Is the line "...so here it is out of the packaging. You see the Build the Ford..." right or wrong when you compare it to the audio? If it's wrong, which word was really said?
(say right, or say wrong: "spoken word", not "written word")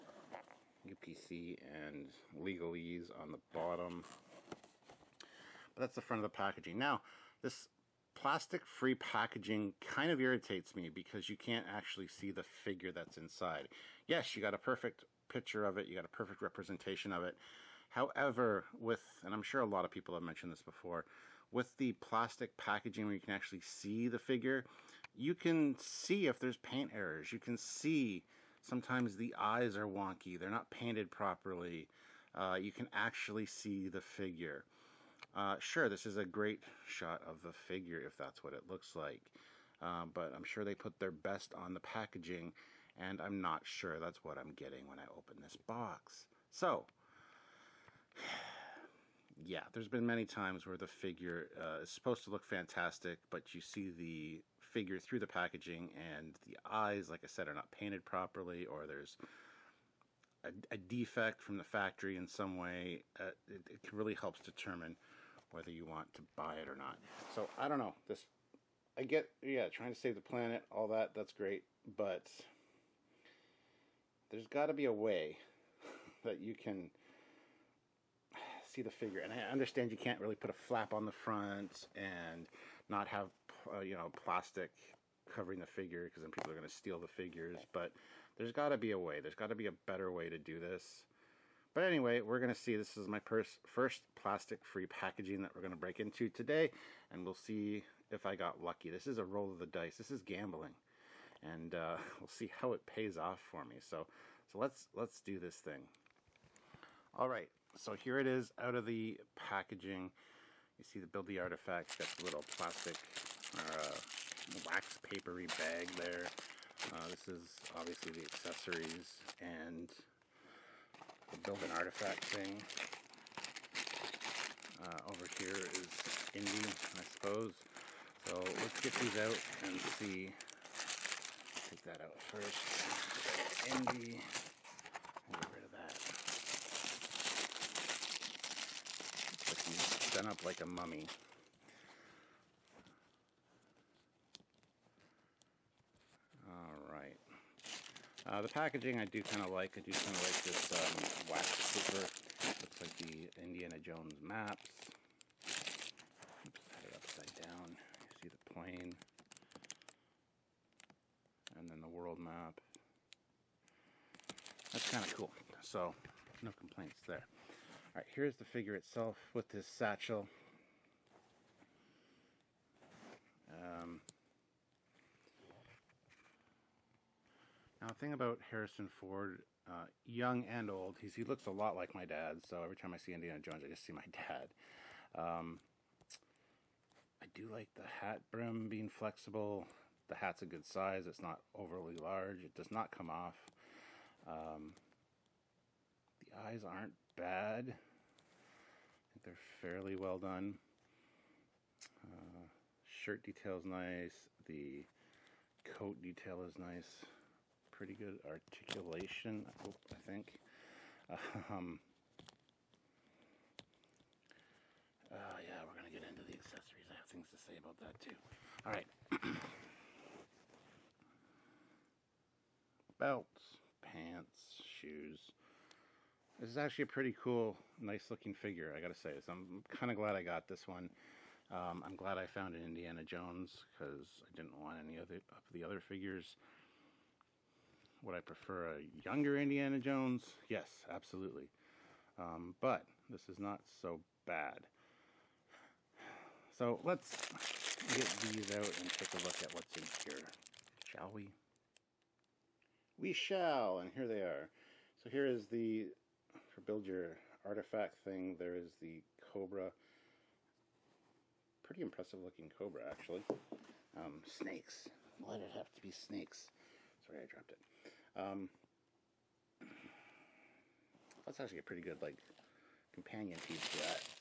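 wrong: "Artifact", not "Ford".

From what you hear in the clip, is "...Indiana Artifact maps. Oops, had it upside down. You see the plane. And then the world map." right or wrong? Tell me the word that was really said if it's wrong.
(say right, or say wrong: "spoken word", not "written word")
wrong: "Jones", not "Artifact".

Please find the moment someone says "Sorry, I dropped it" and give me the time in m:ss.
4:27.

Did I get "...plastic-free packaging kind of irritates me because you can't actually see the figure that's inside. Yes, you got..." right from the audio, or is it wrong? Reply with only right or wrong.
right.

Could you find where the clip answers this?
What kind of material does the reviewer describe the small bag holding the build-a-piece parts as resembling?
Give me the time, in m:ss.
1:54.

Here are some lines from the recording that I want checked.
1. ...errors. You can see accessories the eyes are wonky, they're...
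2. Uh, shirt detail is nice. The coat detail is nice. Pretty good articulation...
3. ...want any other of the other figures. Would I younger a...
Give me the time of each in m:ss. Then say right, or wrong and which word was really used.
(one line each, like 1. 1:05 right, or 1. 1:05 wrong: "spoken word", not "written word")
1. 0:26 wrong: "sometimes", not "accessories"
2. 3:22 right
3. 3:54 wrong: "prefer", not "younger".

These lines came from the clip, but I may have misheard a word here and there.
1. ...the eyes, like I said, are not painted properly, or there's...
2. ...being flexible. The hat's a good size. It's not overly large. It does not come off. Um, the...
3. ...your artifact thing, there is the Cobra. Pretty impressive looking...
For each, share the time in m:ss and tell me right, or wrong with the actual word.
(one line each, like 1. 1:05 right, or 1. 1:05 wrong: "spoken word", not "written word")
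1. 0:56 right
2. 3:08 right
3. 4:16 right.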